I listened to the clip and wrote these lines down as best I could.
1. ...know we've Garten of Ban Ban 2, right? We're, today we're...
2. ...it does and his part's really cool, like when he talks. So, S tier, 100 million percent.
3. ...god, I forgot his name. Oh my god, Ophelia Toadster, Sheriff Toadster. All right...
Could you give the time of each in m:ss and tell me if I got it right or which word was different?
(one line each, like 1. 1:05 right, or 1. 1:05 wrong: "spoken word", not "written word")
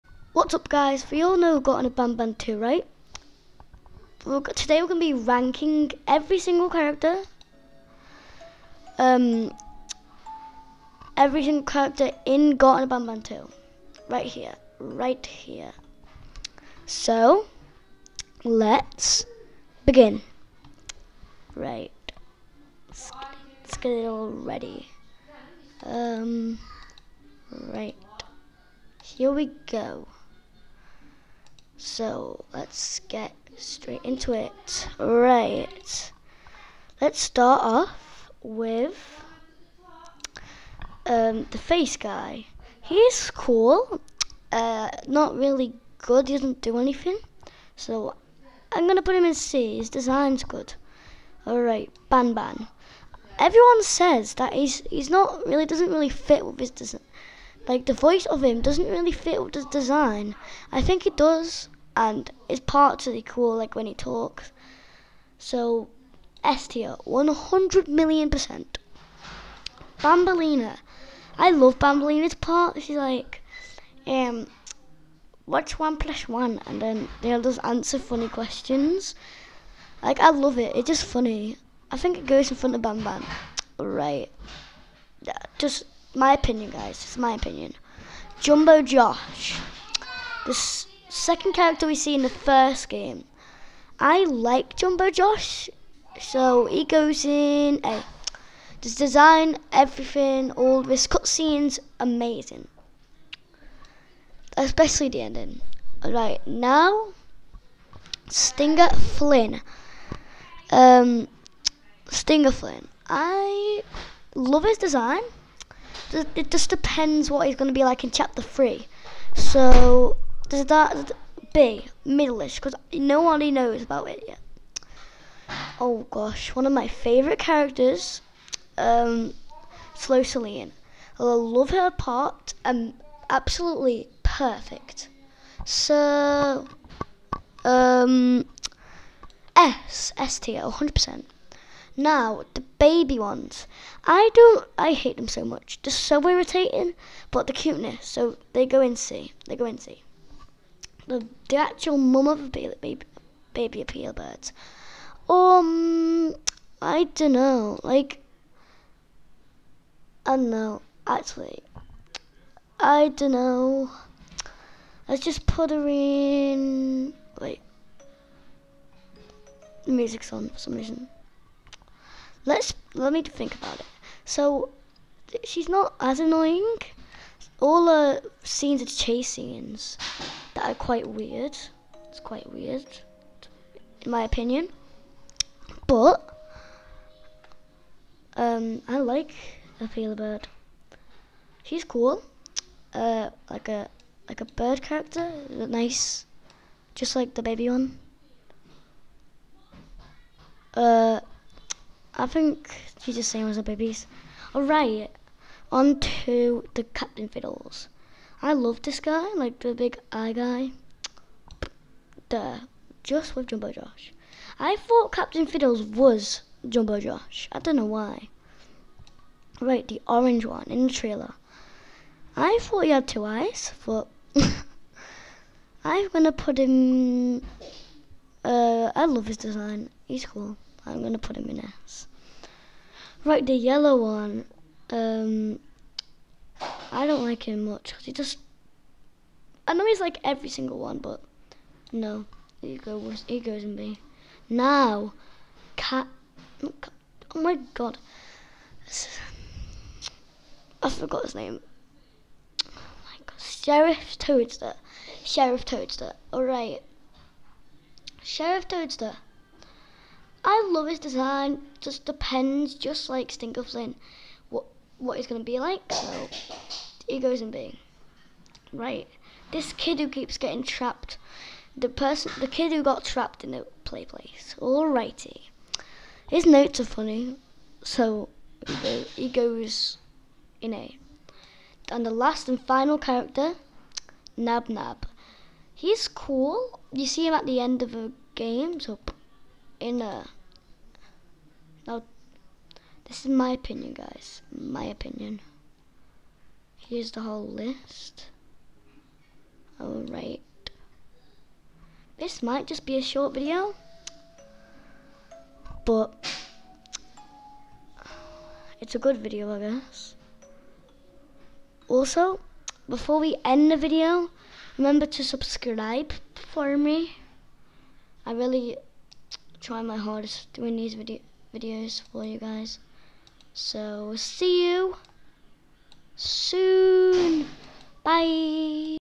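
1. 0:01 right
2. 1:01 right
3. 4:07 wrong: "Sheriff", not "Ophelia".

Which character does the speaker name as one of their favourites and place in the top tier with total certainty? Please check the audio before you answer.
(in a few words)
Slow Seline.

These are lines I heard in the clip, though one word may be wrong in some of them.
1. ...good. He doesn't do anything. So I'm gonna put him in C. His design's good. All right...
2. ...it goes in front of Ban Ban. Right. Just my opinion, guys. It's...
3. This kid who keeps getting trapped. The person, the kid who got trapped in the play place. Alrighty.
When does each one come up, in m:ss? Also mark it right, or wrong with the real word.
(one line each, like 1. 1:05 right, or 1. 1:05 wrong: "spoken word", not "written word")
1. 0:45 right
2. 1:22 right
3. 4:29 right.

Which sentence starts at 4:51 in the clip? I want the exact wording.
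Now, this is my opinion, guys.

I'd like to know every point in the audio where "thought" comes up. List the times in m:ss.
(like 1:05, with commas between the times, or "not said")
3:34, 3:42.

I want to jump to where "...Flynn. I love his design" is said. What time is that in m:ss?
1:52.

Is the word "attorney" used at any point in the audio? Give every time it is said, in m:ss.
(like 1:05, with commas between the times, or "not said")
not said.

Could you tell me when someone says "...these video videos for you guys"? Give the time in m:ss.
5:20.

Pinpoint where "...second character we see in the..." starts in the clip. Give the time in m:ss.
1:31.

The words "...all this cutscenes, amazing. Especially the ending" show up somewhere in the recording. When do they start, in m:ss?
1:40.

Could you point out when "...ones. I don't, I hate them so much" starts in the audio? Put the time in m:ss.
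2:23.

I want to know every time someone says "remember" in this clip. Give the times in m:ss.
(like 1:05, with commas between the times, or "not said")
5:14.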